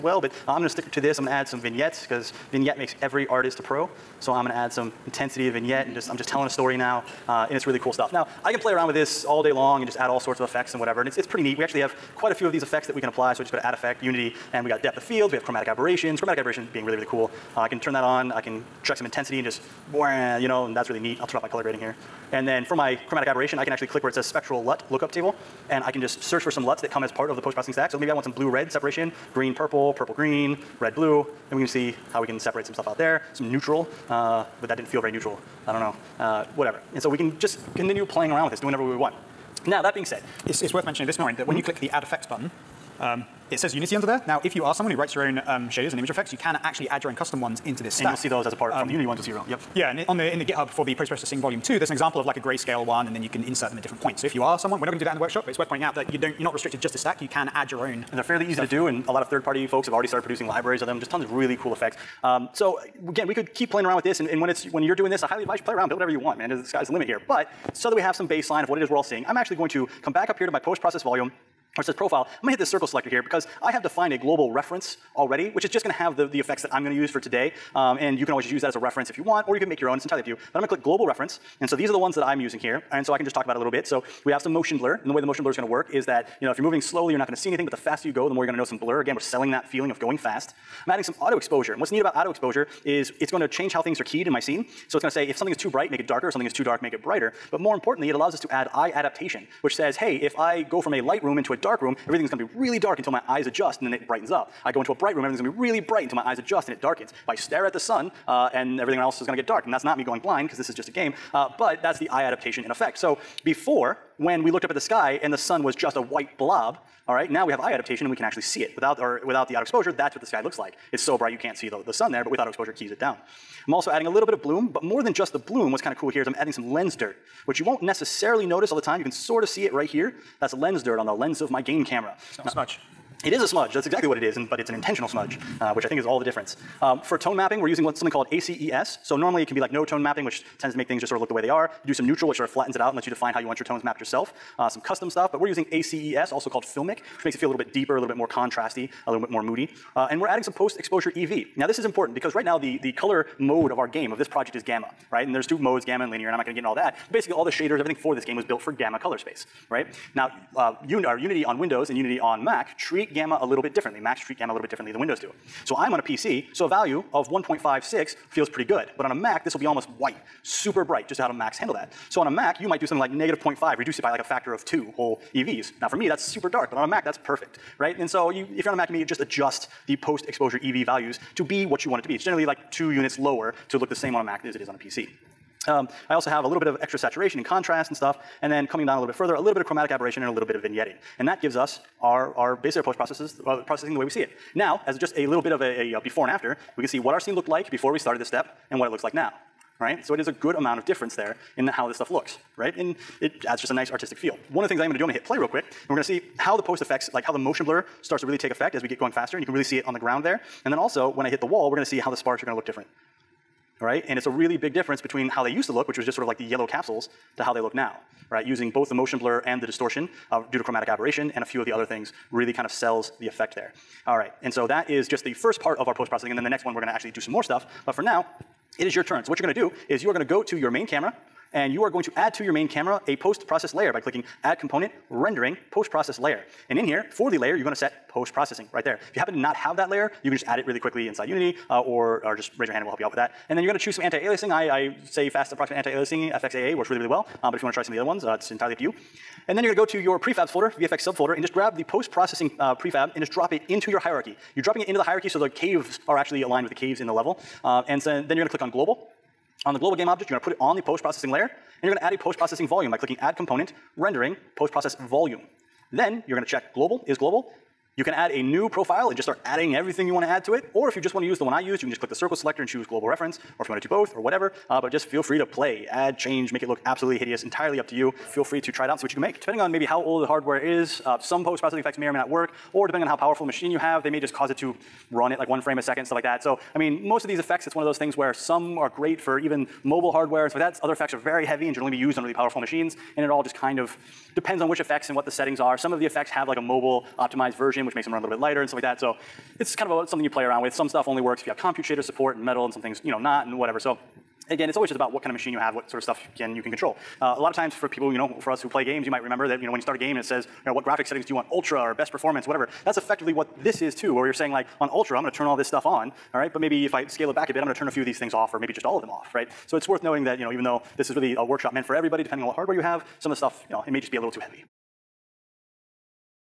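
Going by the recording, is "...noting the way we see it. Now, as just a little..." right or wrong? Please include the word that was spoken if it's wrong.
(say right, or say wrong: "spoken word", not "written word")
wrong: "processing", not "noting".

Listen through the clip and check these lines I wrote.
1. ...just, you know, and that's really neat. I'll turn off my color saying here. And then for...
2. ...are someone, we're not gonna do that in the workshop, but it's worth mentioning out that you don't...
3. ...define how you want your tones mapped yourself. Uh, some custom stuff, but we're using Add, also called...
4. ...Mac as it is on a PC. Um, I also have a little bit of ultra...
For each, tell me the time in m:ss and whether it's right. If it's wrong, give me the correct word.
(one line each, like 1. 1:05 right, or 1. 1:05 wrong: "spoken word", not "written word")
1. 0:19 wrong: "grading", not "saying"
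2. 0:54 wrong: "pointing", not "mentioning"
3. 2:23 wrong: "ACES", not "Add"
4. 3:04 wrong: "extra", not "ultra".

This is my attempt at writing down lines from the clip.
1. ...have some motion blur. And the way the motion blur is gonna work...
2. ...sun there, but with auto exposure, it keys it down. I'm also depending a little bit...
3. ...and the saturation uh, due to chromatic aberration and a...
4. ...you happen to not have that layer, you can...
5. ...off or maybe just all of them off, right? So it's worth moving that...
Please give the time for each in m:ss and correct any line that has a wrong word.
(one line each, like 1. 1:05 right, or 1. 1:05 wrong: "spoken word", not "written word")
1. 1:24 right
2. 2:01 wrong: "adding", not "depending"
3. 3:39 wrong: "distortion", not "saturation"
4. 3:59 right
5. 5:18 wrong: "noting", not "moving".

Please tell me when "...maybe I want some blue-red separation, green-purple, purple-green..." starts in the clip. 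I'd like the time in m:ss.
0:27.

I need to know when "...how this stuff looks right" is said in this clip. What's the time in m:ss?
3:21.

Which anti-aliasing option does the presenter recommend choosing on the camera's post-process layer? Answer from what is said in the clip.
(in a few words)
FXAA.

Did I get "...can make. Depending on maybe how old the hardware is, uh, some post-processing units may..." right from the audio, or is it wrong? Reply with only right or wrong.
wrong.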